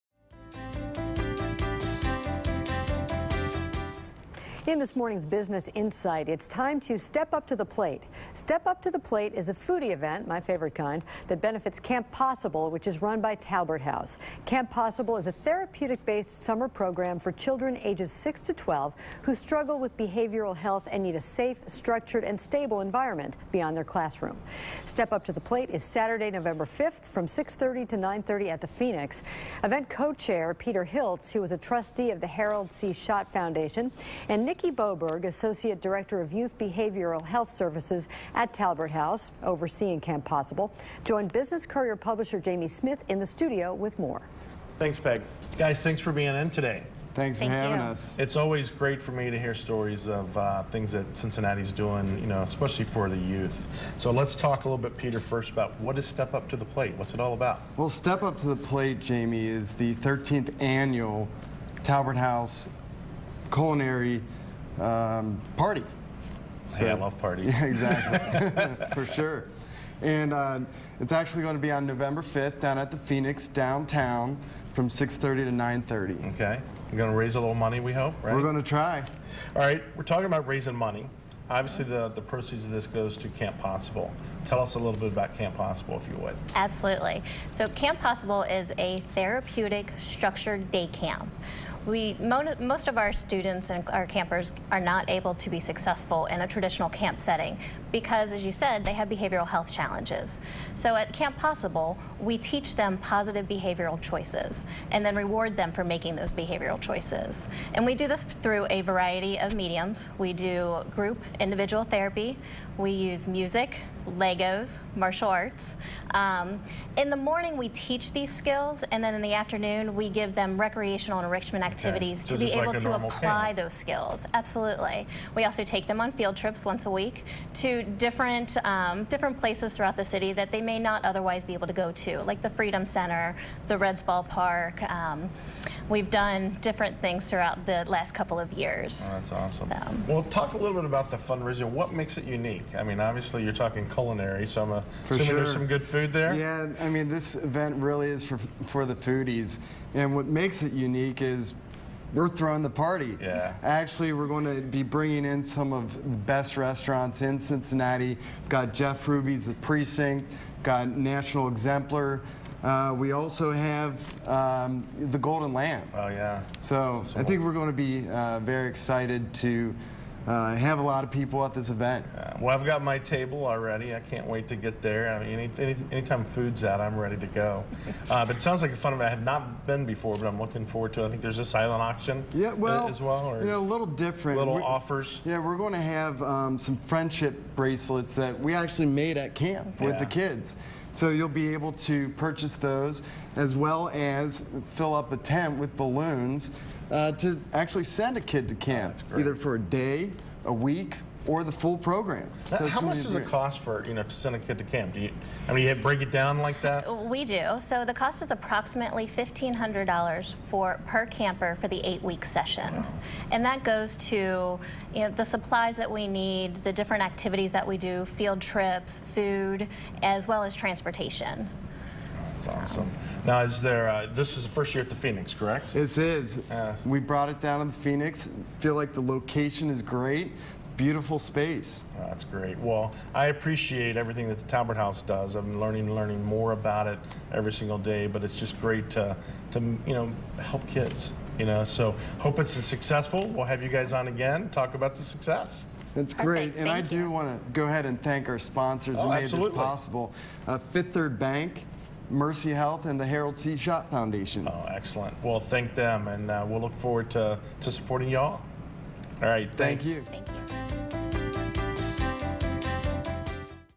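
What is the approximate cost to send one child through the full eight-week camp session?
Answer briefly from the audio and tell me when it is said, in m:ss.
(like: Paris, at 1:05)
$1,500, at 3:29.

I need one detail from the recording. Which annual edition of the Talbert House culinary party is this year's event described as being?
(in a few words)
13th.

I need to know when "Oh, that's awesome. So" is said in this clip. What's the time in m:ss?
2:19.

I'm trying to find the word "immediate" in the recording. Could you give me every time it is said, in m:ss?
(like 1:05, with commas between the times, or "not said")
not said.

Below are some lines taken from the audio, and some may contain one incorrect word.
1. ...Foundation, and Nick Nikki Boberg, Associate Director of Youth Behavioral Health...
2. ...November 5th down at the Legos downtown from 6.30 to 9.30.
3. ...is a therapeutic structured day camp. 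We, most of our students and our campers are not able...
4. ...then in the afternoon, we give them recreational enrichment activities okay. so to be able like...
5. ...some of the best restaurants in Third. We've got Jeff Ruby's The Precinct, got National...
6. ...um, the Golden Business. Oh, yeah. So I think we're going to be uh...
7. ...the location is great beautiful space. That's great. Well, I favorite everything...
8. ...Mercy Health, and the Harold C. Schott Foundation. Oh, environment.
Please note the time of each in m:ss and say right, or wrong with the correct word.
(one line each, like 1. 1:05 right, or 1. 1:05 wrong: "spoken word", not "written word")
1. 0:33 right
2. 1:11 wrong: "Phoenix", not "Legos"
3. 1:28 right
4. 1:59 right
5. 2:35 wrong: "Cincinnati", not "Third"
6. 2:44 wrong: "Lamb", not "Business"
7. 3:48 wrong: "appreciate", not "favorite"
8. 4:12 wrong: "excellent", not "environment".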